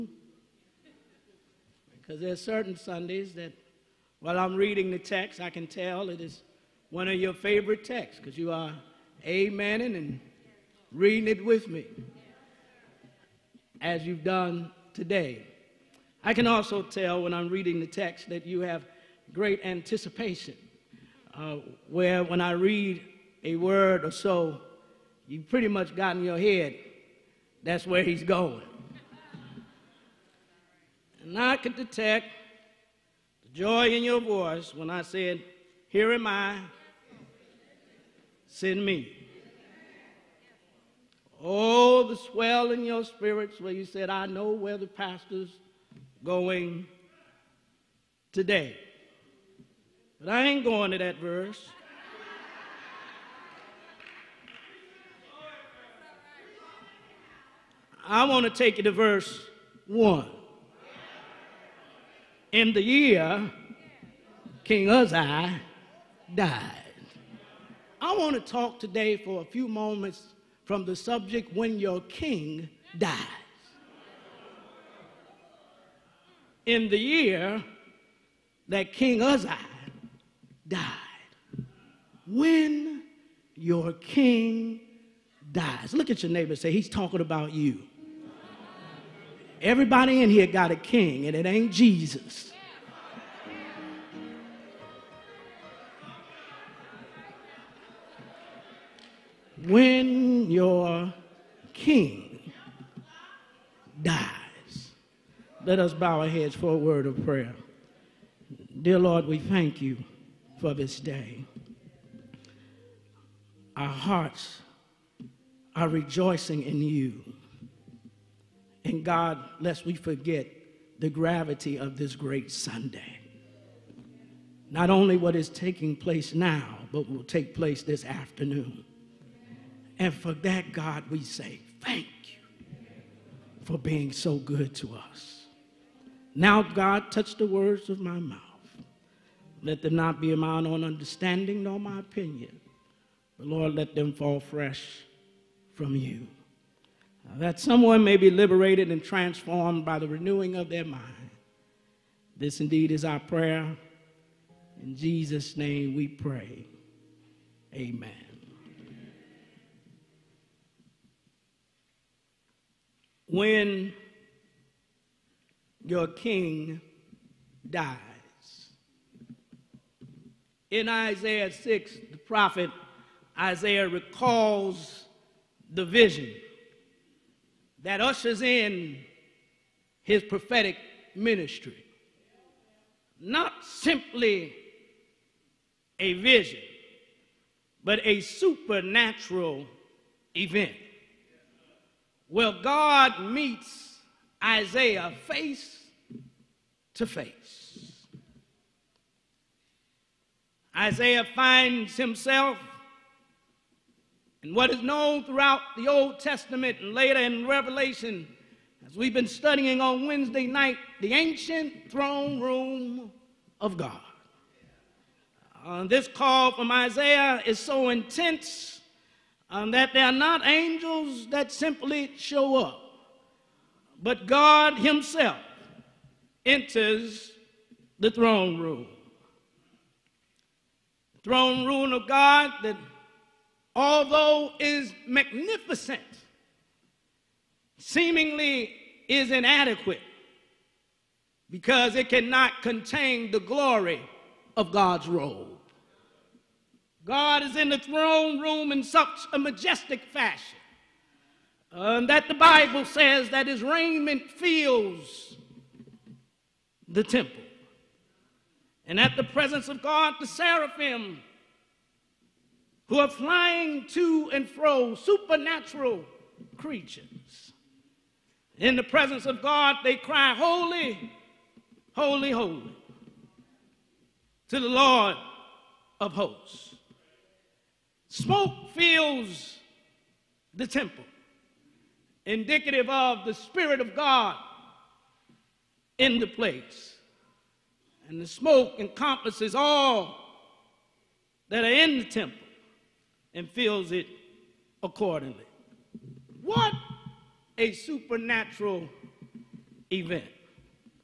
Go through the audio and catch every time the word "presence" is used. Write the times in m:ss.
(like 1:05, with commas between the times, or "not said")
4:19, 4:28.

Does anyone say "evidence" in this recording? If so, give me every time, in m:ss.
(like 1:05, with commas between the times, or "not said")
not said.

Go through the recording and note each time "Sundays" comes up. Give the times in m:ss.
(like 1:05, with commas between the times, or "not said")
0:02, 2:02.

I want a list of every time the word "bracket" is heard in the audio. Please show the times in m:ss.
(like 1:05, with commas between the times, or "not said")
not said.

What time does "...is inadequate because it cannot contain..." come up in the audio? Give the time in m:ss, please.
3:59.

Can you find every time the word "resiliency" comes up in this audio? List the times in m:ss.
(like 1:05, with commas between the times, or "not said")
not said.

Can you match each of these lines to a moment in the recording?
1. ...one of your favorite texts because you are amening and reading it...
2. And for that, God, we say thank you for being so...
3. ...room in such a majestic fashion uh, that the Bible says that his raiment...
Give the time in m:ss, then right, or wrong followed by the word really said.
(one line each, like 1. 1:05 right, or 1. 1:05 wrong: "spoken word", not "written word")
1. 0:06 right
2. 2:09 right
3. 4:08 right.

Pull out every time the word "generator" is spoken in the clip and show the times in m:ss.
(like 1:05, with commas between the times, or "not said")
not said.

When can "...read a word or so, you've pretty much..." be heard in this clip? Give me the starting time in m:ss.
0:22.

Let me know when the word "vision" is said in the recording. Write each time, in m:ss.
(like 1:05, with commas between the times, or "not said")
2:55, 3:06.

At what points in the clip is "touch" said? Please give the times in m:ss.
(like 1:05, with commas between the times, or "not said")
2:17.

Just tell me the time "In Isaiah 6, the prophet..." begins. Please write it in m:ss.
2:50.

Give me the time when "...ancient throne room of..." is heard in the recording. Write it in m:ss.
3:31.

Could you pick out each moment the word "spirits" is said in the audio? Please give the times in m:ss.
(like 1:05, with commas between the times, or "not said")
0:43, 4:43.